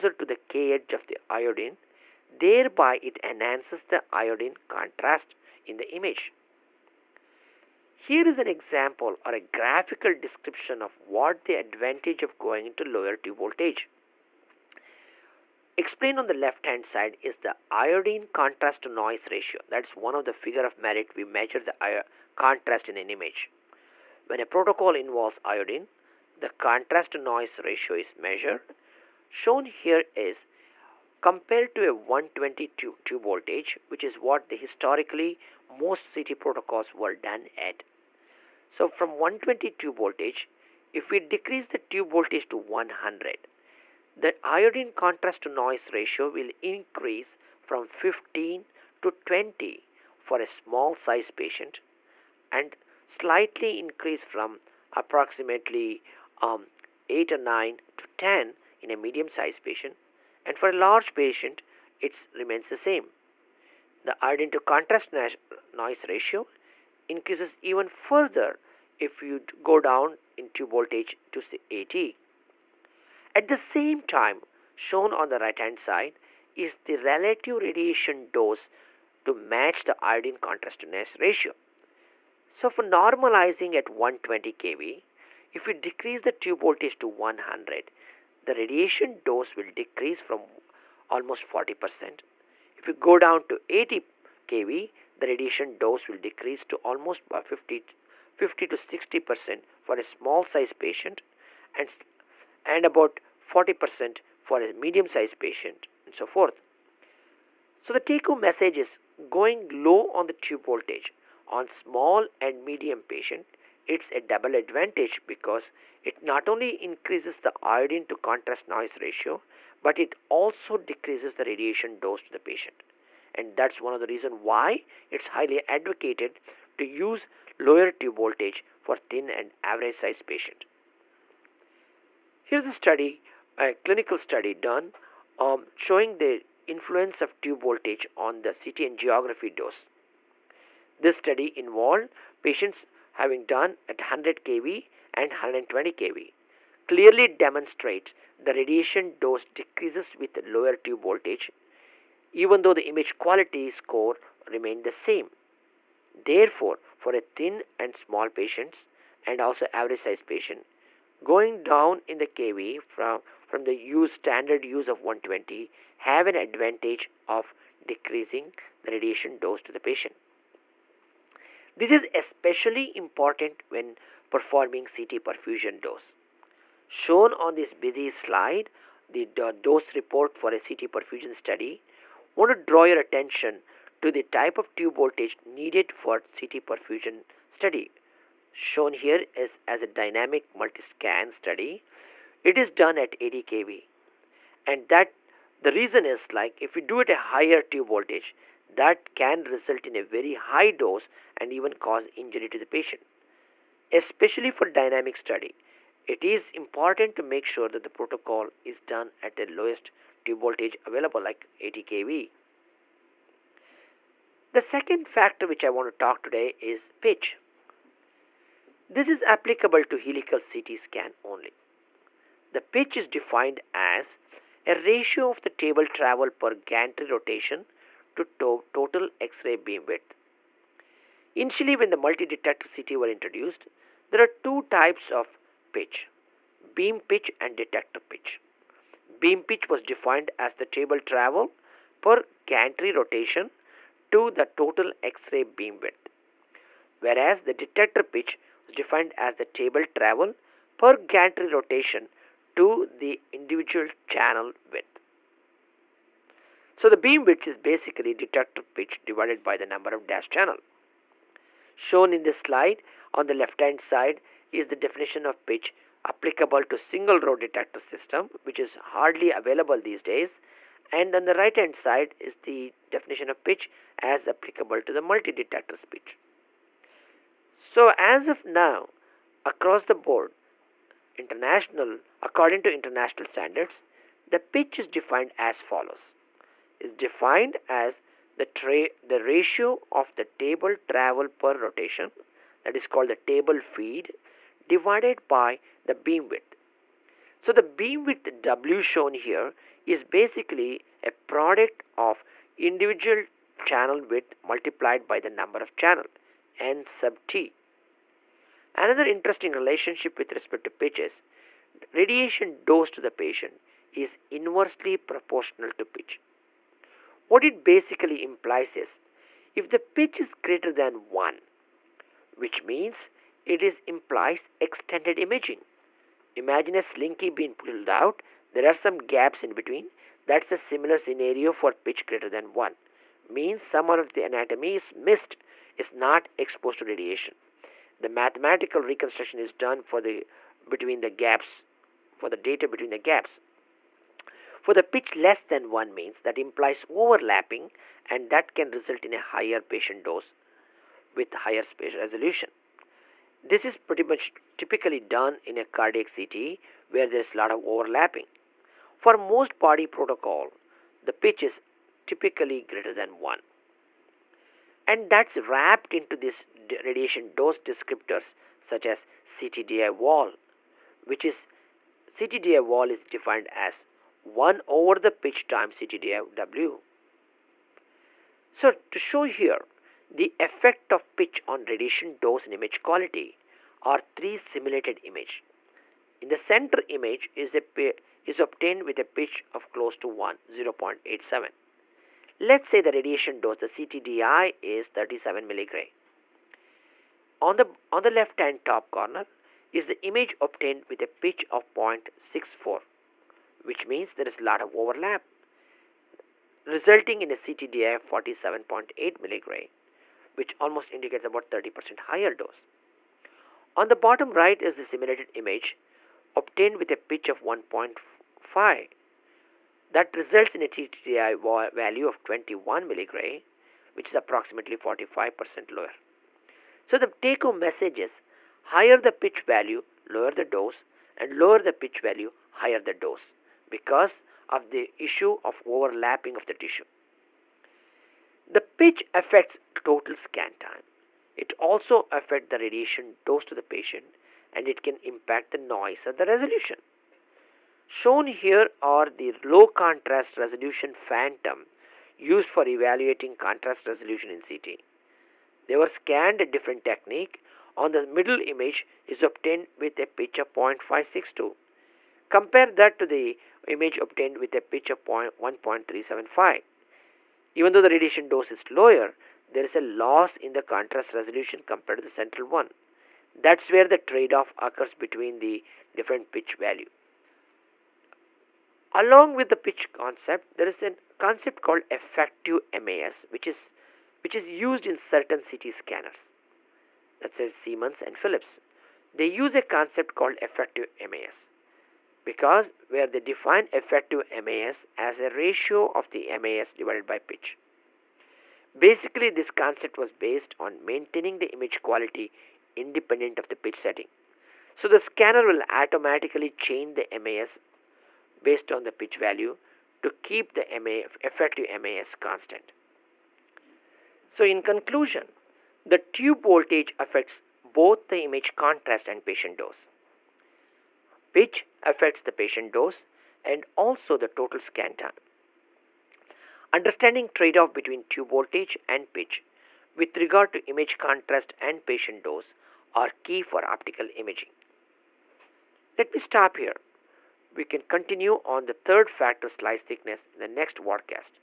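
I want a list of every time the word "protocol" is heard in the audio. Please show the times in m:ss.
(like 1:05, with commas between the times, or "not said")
0:24, 0:36, 3:27, 5:59.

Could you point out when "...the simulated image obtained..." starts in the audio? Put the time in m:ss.
6:54.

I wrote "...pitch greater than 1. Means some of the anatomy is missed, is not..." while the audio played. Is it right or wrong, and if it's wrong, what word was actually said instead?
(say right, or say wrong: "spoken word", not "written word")
right.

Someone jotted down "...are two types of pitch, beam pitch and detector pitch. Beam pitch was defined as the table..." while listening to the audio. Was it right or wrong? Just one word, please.
right.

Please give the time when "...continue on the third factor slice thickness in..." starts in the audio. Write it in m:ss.
8:57.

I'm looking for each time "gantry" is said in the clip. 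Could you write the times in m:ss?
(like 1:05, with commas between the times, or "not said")
3:46, 4:02, 4:10.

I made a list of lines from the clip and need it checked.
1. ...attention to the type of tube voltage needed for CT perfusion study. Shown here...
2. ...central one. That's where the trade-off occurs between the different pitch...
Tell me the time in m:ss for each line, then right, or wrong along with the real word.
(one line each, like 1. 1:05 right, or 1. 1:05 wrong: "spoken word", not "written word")
1. 3:02 right
2. 7:52 right.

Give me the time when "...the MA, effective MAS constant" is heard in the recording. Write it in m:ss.
8:30.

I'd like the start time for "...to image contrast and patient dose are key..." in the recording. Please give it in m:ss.
8:50.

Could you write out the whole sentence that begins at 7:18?
The pitch affects total scan time.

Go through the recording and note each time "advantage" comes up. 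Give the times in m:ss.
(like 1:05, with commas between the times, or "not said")
0:11, 1:54, 2:46.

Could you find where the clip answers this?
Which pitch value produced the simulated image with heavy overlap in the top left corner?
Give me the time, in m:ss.
6:41.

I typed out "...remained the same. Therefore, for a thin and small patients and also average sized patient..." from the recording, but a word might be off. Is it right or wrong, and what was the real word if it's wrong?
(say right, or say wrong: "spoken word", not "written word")
right.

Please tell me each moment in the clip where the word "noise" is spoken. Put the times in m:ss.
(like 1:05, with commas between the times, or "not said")
0:18, 0:27, 0:45, 1:05, 1:58, 7:25.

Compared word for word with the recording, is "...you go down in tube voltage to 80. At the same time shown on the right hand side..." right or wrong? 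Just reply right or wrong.
right.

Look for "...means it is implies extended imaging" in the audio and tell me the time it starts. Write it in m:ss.
5:22.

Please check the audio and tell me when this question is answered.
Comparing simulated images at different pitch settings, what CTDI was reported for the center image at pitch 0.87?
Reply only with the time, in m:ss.
6:34.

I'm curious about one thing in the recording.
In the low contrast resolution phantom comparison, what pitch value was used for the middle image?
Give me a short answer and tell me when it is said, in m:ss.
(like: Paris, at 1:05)
0.562, at 7:40.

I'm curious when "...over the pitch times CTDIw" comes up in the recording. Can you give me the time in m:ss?
6:14.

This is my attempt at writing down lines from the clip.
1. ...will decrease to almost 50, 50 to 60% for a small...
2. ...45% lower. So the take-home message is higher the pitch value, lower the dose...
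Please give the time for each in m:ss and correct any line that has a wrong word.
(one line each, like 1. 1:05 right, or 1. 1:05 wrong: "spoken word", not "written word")
1. 1:36 right
2. 7:04 right.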